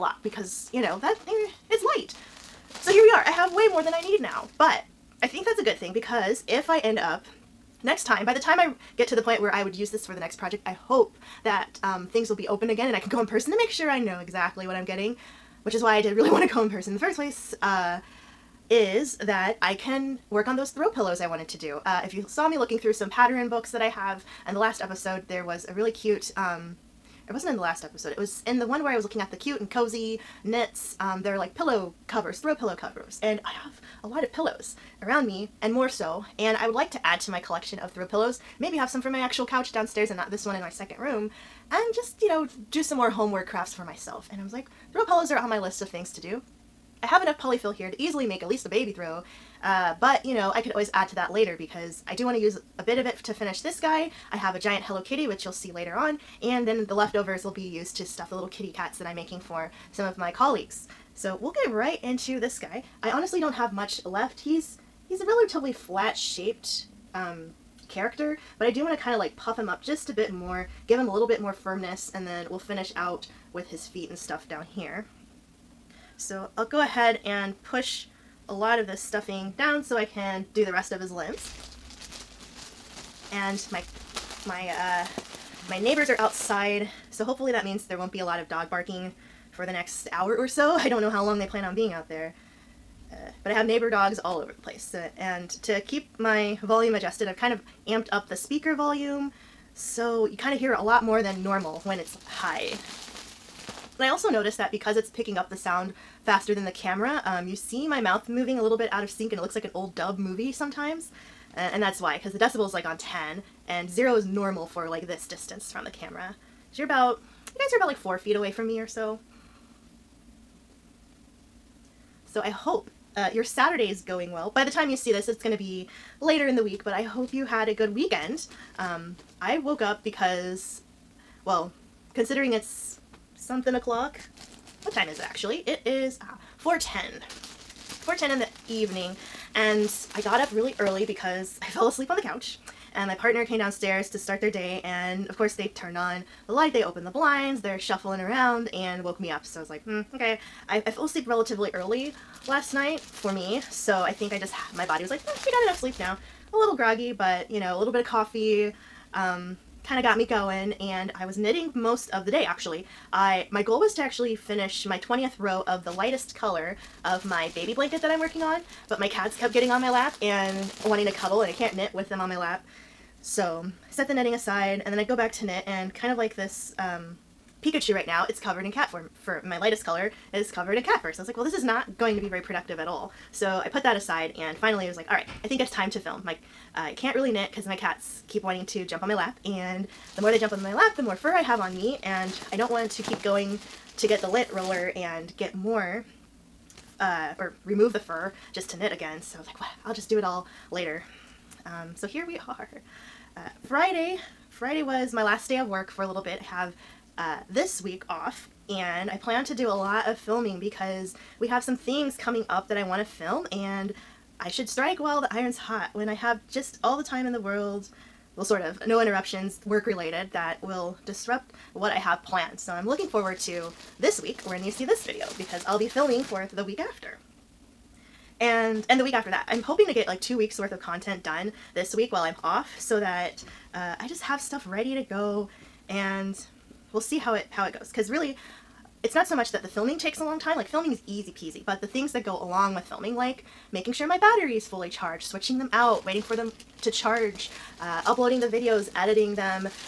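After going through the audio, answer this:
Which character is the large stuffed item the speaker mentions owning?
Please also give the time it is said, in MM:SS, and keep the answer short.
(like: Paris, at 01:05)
Hello Kitty, at 00:54.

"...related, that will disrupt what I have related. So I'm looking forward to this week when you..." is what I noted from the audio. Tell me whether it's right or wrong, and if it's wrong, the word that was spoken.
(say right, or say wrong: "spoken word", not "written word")
wrong: "planned", not "related".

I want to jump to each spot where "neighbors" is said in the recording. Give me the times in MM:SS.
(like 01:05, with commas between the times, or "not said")
01:25, 01:33.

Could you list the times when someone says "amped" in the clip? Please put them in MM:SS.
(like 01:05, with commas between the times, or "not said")
01:37.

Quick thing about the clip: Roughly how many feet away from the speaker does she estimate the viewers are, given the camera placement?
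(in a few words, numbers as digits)
4.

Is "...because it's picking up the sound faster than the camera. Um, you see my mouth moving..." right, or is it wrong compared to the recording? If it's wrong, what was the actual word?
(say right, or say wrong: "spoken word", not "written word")
right.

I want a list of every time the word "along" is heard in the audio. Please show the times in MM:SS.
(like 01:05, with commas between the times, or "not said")
04:02.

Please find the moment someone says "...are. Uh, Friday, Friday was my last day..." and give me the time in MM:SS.
03:22.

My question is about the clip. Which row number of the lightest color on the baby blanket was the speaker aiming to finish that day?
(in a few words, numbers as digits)
20th.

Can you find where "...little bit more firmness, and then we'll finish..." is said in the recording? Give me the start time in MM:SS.
01:11.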